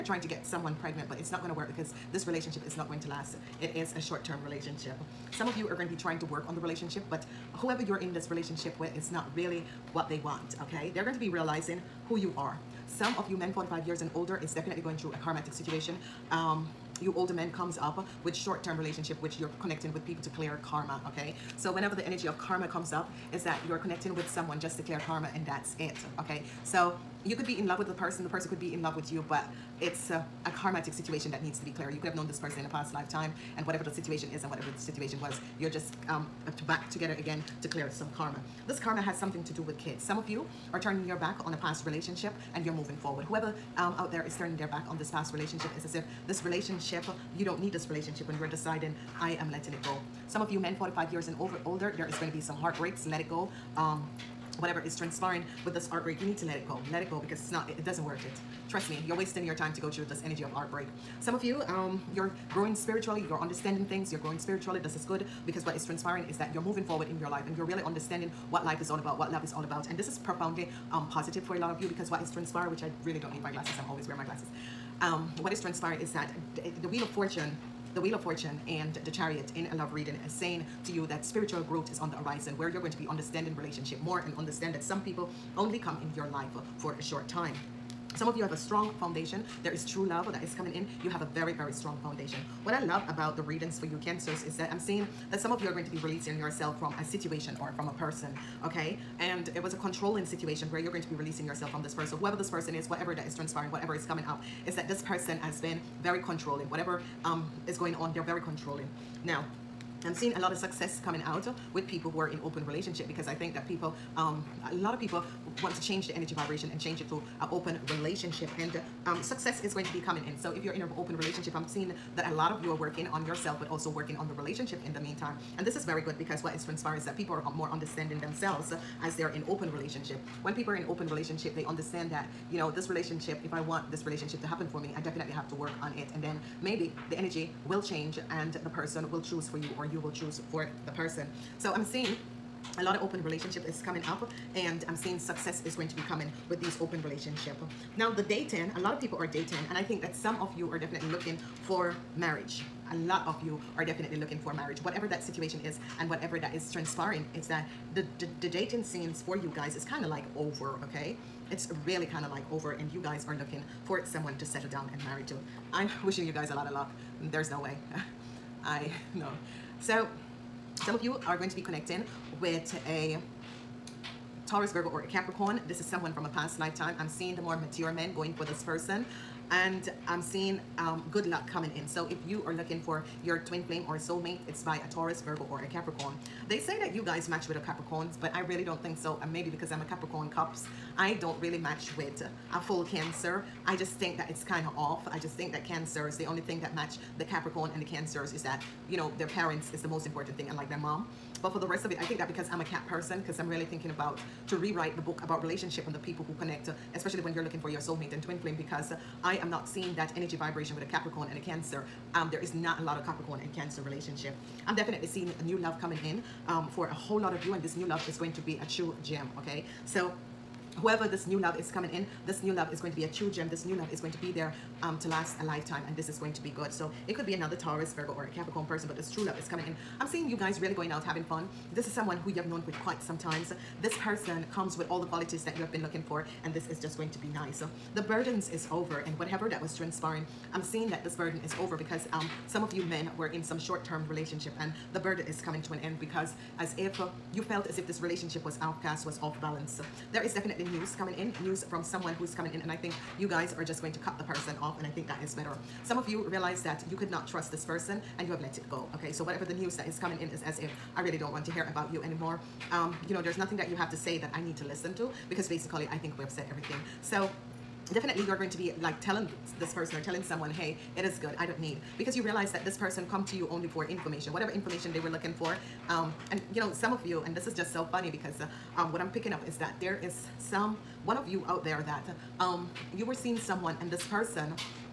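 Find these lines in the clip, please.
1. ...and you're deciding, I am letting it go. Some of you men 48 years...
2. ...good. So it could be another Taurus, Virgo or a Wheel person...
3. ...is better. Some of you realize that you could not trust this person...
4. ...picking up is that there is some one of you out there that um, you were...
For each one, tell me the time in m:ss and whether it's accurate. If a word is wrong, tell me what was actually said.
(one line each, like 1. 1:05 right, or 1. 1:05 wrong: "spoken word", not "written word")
1. 0:48 wrong: "45", not "48"
2. 3:46 wrong: "Capricorn", not "Wheel"
3. 4:15 right
4. 4:39 right.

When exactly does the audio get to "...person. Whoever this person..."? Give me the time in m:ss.
1:41.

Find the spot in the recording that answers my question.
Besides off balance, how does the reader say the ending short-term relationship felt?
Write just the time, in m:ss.
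4:08.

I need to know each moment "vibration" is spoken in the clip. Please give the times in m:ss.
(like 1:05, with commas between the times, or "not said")
1:56, 3:30.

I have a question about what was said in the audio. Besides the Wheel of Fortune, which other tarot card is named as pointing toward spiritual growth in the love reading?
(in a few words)
The Chariot.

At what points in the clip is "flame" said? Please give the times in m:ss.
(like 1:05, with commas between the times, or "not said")
3:03, 3:28.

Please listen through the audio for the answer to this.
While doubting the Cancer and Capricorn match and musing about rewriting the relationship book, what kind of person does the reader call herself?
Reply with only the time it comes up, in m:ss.
3:22.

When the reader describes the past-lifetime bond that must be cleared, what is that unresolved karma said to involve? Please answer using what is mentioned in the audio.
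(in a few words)
Kids.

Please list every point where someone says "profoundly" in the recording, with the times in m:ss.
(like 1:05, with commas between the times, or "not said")
1:10.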